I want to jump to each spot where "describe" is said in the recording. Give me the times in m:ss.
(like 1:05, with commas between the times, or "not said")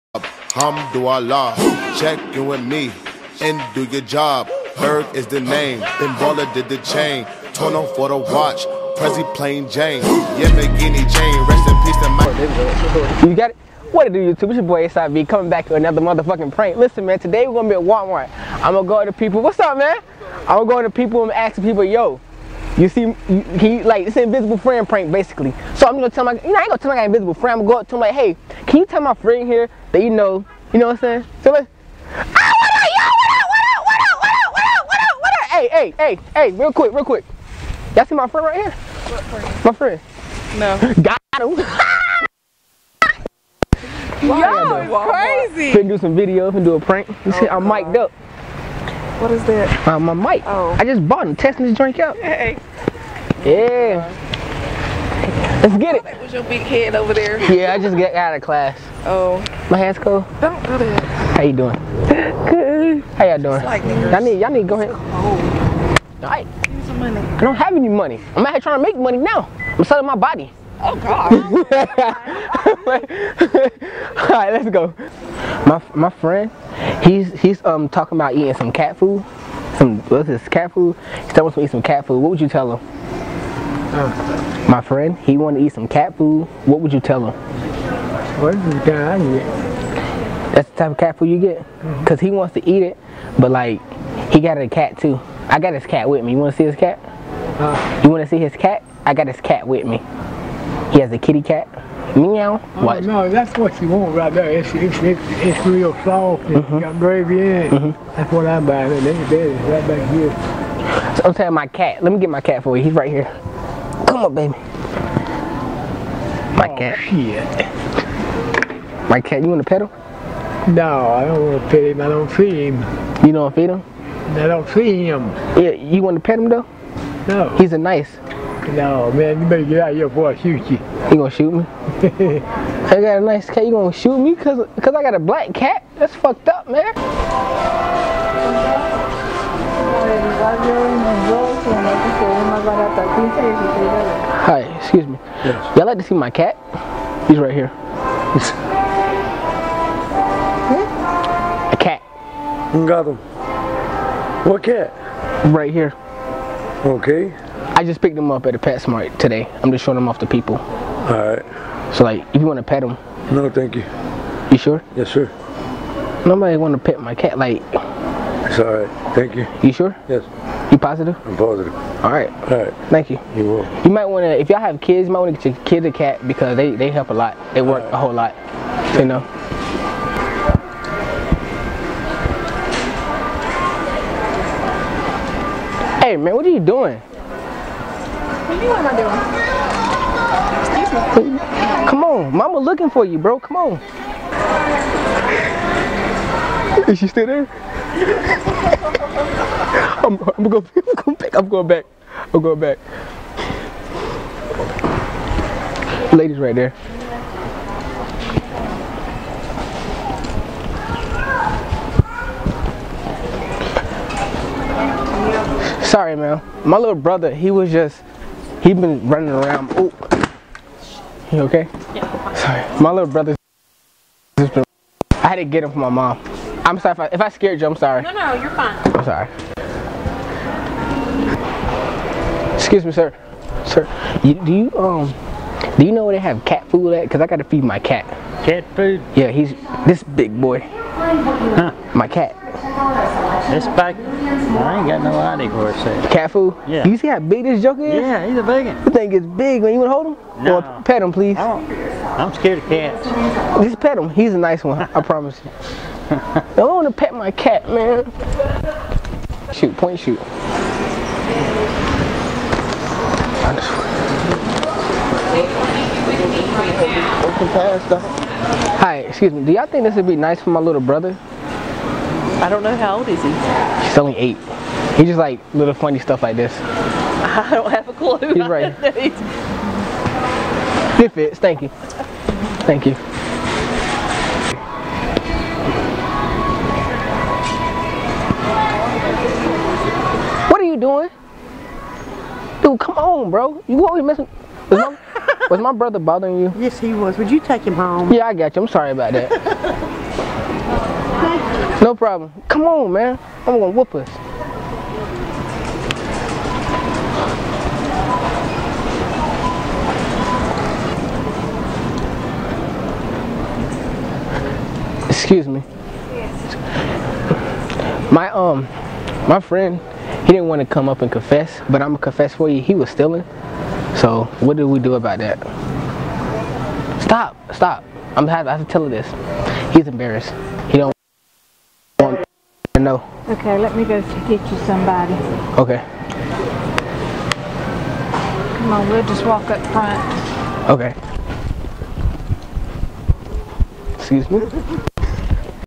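not said.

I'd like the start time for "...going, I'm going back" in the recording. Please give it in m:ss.
3:20.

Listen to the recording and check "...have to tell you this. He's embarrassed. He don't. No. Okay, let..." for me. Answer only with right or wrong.
right.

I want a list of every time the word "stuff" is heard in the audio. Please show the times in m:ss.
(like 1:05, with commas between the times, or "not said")
4:35.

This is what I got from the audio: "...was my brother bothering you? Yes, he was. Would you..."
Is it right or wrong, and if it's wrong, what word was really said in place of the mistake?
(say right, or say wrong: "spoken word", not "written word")
right.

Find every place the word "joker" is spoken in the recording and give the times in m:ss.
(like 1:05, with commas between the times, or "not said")
4:07.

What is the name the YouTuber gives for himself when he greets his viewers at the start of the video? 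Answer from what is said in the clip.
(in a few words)
SIV.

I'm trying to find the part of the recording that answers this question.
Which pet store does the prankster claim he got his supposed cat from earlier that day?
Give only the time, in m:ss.
2:38.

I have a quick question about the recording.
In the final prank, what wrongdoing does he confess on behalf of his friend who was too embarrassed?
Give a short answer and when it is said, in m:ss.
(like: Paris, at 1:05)
stealing, at 5:22.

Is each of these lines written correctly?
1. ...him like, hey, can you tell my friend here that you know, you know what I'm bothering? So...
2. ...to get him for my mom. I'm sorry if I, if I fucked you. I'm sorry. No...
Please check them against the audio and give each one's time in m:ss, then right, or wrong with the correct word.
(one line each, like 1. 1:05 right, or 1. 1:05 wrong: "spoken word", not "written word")
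1. 0:27 wrong: "saying", not "bothering"
2. 3:45 wrong: "scared", not "fucked".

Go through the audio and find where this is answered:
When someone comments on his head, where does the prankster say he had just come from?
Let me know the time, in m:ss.
0:58.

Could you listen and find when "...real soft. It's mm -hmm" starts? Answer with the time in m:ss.
1:45.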